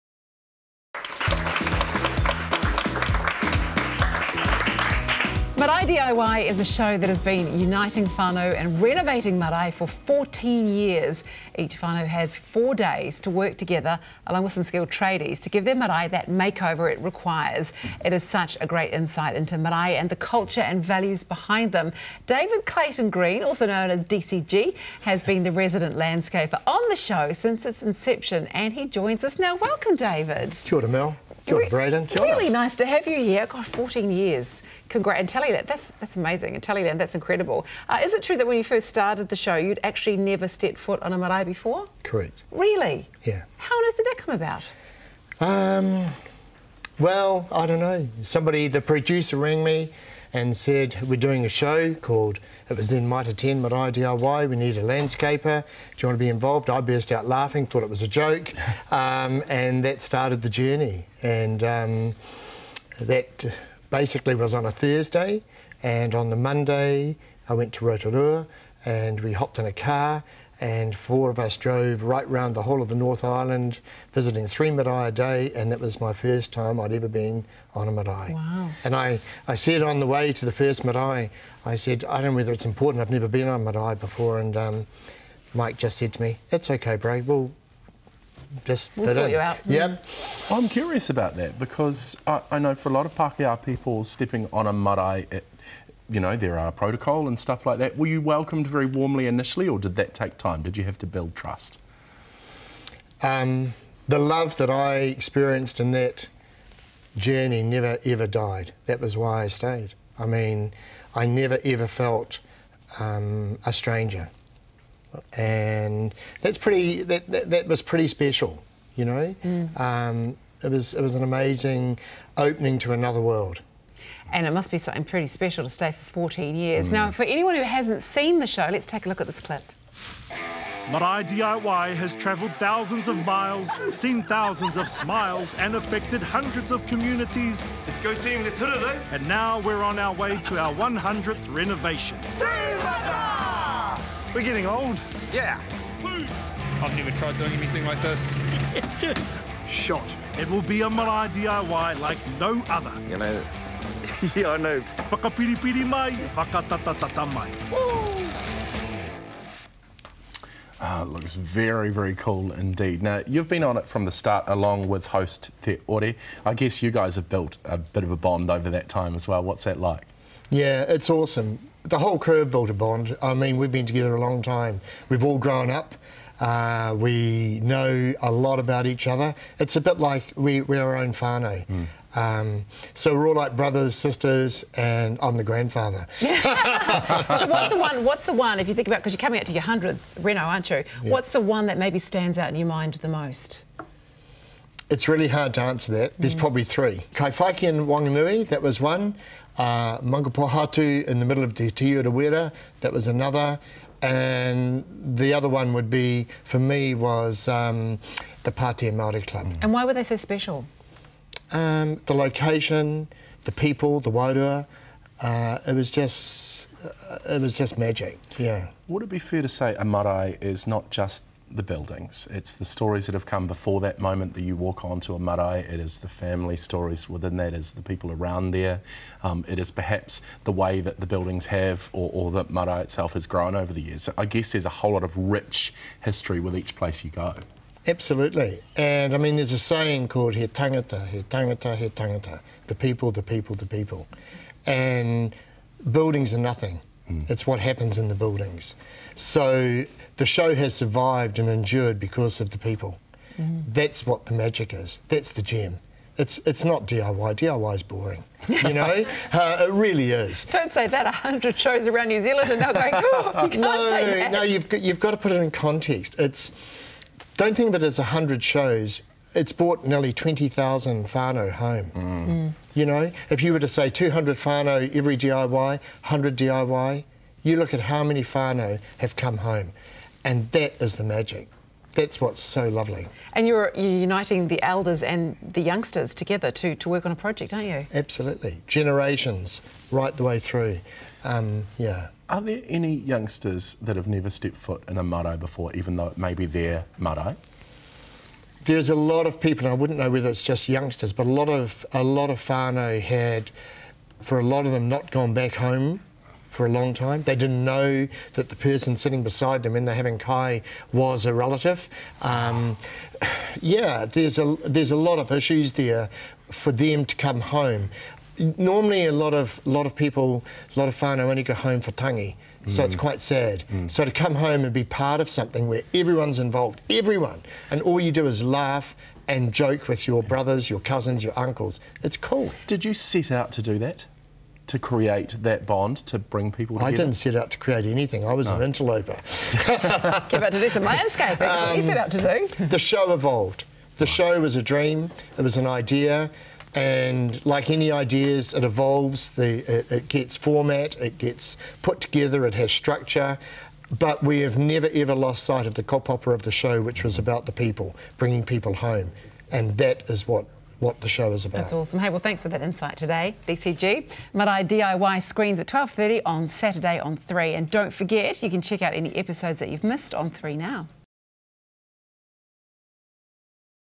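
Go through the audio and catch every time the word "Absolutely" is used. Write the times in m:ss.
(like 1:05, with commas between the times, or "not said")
3:57, 4:47.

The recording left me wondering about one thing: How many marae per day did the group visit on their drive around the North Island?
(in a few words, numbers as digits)
3.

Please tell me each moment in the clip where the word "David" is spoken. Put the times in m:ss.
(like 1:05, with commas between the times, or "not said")
0:22, 0:29.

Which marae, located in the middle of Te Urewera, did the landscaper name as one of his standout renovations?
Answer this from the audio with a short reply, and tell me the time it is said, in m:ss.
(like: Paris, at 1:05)
Maungapōhatu, at 3:19.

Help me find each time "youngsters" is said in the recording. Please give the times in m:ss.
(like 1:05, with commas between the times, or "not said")
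4:45, 4:52, 5:00.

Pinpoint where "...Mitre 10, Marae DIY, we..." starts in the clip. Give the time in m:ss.
0:53.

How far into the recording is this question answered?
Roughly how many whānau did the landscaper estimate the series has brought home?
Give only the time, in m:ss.
4:30.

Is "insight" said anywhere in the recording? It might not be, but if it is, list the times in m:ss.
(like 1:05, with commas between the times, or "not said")
0:18, 6:02.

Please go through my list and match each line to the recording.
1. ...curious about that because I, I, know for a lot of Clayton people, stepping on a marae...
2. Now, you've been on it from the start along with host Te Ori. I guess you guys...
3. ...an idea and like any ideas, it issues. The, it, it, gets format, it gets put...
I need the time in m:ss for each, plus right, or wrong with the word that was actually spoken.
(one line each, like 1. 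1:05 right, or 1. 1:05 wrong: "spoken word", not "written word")
1. 1:30 wrong: "Pākehā", not "Clayton"
2. 2:43 right
3. 5:45 wrong: "evolves", not "issues".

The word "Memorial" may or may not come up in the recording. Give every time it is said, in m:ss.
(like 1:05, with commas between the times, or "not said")
not said.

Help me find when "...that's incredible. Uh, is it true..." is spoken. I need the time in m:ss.
0:36.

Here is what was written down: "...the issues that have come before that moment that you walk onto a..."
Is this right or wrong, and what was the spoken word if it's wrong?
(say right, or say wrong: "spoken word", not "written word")
wrong: "stories", not "issues".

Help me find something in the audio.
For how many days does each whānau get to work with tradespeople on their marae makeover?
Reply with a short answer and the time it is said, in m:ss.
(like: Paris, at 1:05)
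4, at 0:12.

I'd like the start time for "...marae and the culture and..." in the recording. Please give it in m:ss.
0:19.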